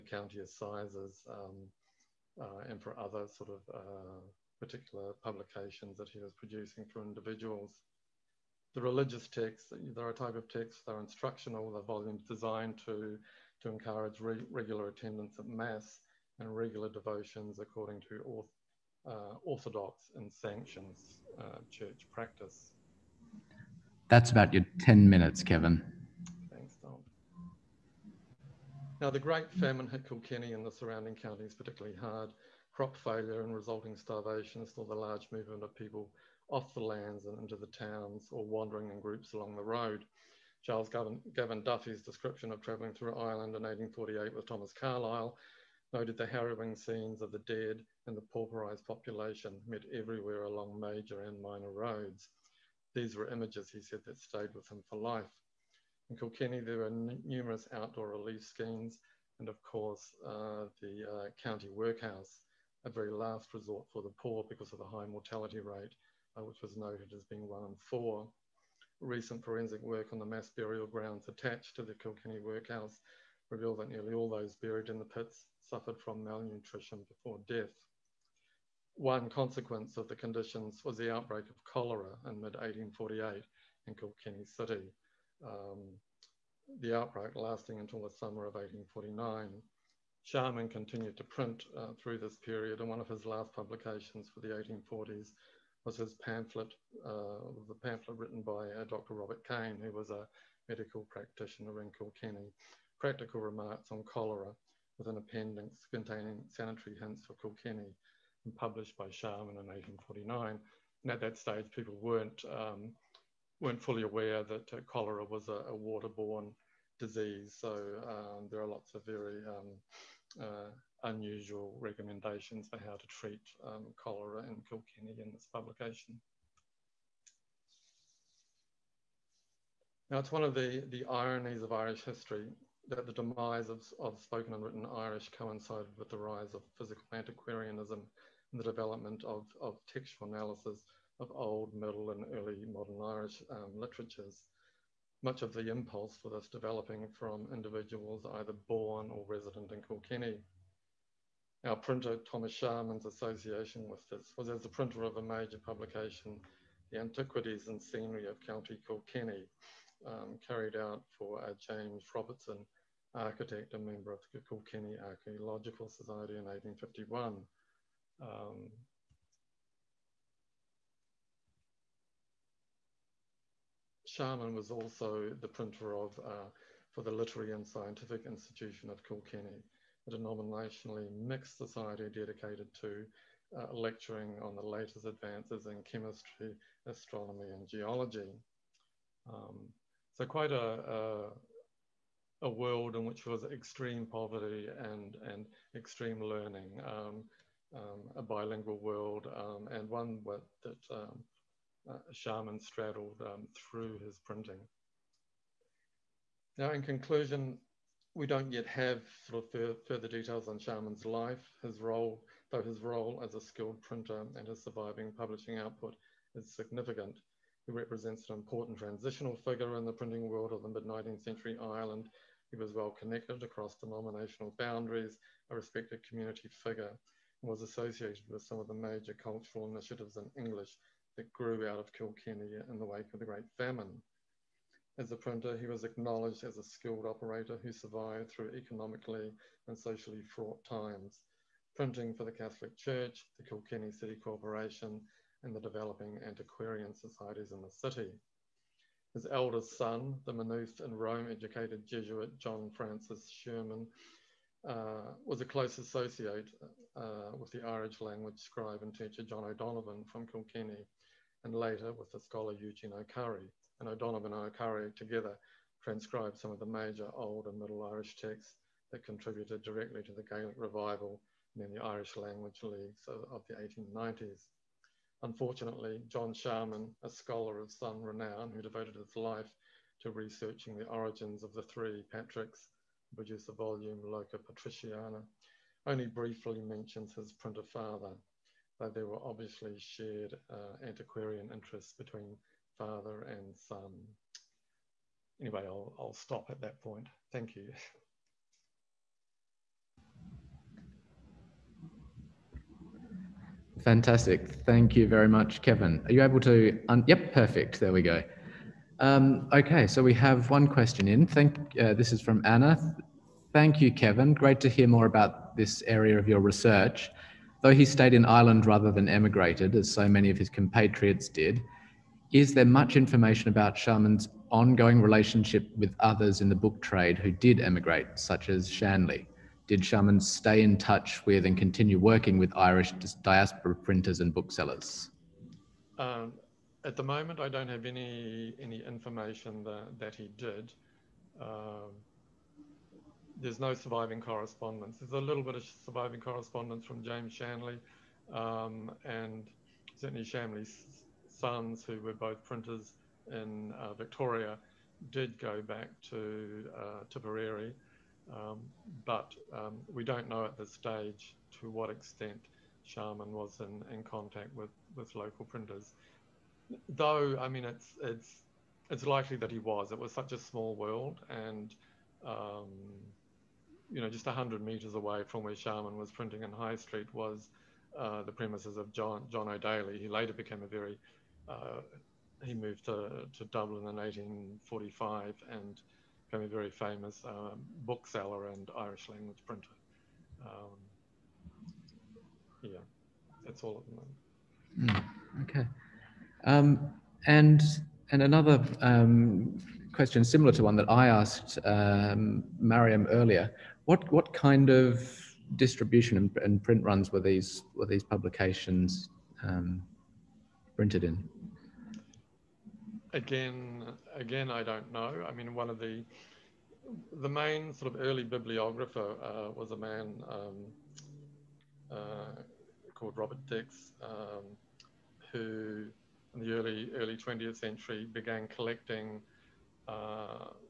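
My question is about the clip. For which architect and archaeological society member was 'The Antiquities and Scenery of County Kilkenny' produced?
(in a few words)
James Robertson.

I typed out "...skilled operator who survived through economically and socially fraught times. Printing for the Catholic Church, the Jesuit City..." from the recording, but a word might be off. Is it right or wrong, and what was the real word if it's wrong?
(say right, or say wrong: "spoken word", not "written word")
wrong: "Kilkenny", not "Jesuit".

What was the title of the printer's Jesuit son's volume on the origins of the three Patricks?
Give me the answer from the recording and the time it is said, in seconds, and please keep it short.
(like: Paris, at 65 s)
Loca Patriciana, at 284 s.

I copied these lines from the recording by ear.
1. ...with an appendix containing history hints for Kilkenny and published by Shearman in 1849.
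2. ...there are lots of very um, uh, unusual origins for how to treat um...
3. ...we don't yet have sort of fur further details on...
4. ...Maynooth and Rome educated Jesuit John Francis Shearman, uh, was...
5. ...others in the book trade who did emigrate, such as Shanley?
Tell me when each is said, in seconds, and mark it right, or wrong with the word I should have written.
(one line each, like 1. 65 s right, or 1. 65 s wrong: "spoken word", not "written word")
1. 104 s wrong: "sanitary", not "history"
2. 118 s wrong: "recommendations", not "origins"
3. 208 s right
4. 250 s right
5. 326 s right.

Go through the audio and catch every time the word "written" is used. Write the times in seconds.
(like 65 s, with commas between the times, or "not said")
98 s, 134 s.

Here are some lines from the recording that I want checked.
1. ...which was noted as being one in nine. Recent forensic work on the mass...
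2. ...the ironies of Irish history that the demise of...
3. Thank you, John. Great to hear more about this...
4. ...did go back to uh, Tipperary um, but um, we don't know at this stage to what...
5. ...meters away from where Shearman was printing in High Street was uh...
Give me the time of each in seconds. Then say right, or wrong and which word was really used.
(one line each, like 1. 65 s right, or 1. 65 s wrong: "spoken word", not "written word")
1. 66 s wrong: "four", not "nine"
2. 130 s right
3. 313 s wrong: "Kevin", not "John"
4. 355 s right
5. 374 s right.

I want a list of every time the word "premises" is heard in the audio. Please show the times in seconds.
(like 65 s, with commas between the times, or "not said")
378 s.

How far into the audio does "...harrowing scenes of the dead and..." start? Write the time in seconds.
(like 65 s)
46 s.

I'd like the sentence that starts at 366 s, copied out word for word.
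Though, I mean, it's, it's, it's likely that he was.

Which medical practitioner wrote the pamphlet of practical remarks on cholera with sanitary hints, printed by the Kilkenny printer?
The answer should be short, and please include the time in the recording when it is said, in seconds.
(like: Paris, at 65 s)
Dr. Robert Kane, at 98 s.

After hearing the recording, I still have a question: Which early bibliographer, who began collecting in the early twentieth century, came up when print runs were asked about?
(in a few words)
Robert Dix.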